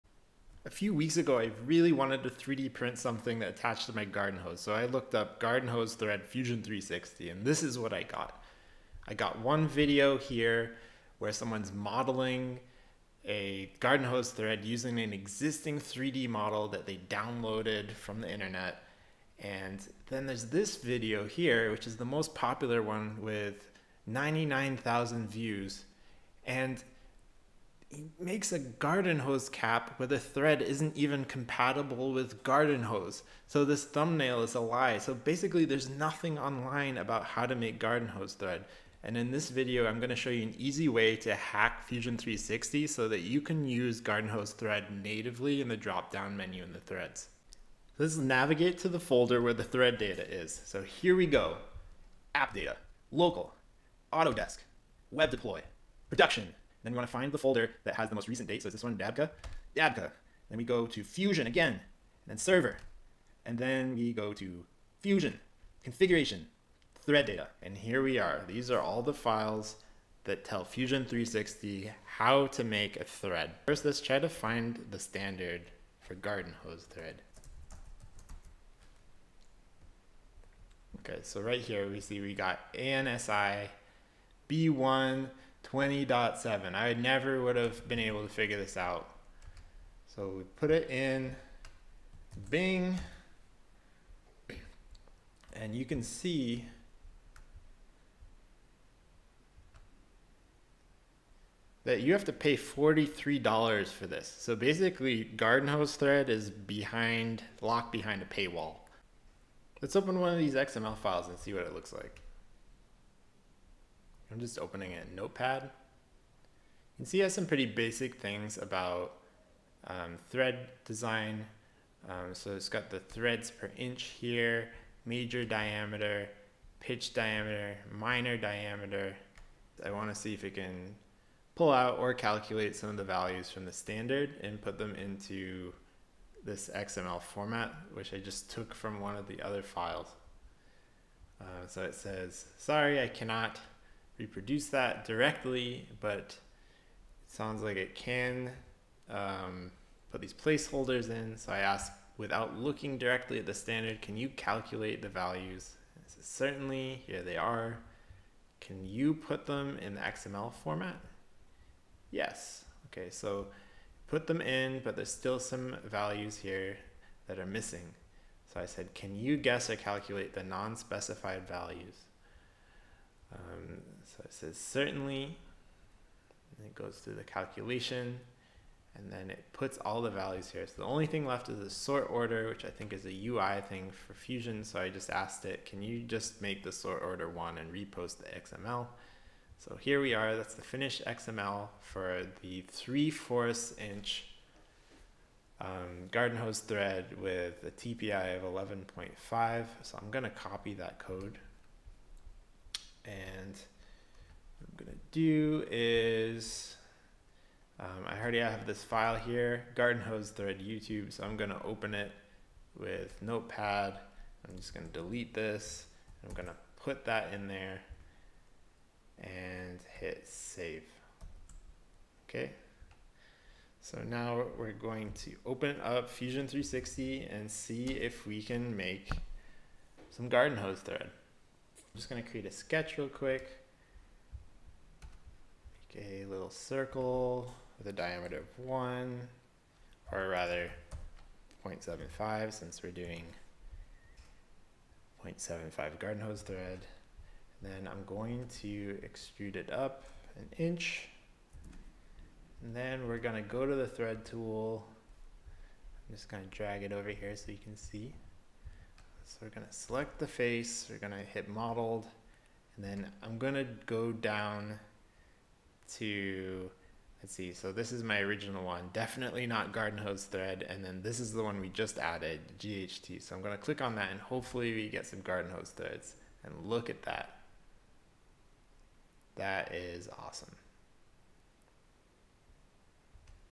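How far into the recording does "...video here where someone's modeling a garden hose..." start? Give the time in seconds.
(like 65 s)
9 s.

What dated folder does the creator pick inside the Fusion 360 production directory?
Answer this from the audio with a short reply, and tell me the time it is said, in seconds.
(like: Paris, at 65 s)
Dabka, at 59 s.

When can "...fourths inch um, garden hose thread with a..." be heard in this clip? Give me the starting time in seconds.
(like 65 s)
193 s.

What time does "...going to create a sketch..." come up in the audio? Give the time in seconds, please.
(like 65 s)
232 s.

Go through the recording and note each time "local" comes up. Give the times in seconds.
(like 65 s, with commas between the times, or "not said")
53 s.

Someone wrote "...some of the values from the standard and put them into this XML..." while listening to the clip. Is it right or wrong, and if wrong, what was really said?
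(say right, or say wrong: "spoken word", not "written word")
right.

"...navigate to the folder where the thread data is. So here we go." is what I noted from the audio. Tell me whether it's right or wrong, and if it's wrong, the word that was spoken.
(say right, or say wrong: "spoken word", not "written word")
right.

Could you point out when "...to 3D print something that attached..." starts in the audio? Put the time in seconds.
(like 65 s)
2 s.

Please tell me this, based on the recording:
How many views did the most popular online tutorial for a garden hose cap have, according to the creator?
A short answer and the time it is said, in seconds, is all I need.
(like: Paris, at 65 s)
99,000, at 24 s.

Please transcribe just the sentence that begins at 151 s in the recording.
So I ask, without looking directly at the standard, can you calculate the values?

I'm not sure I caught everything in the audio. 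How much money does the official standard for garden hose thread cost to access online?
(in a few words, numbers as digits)
$43.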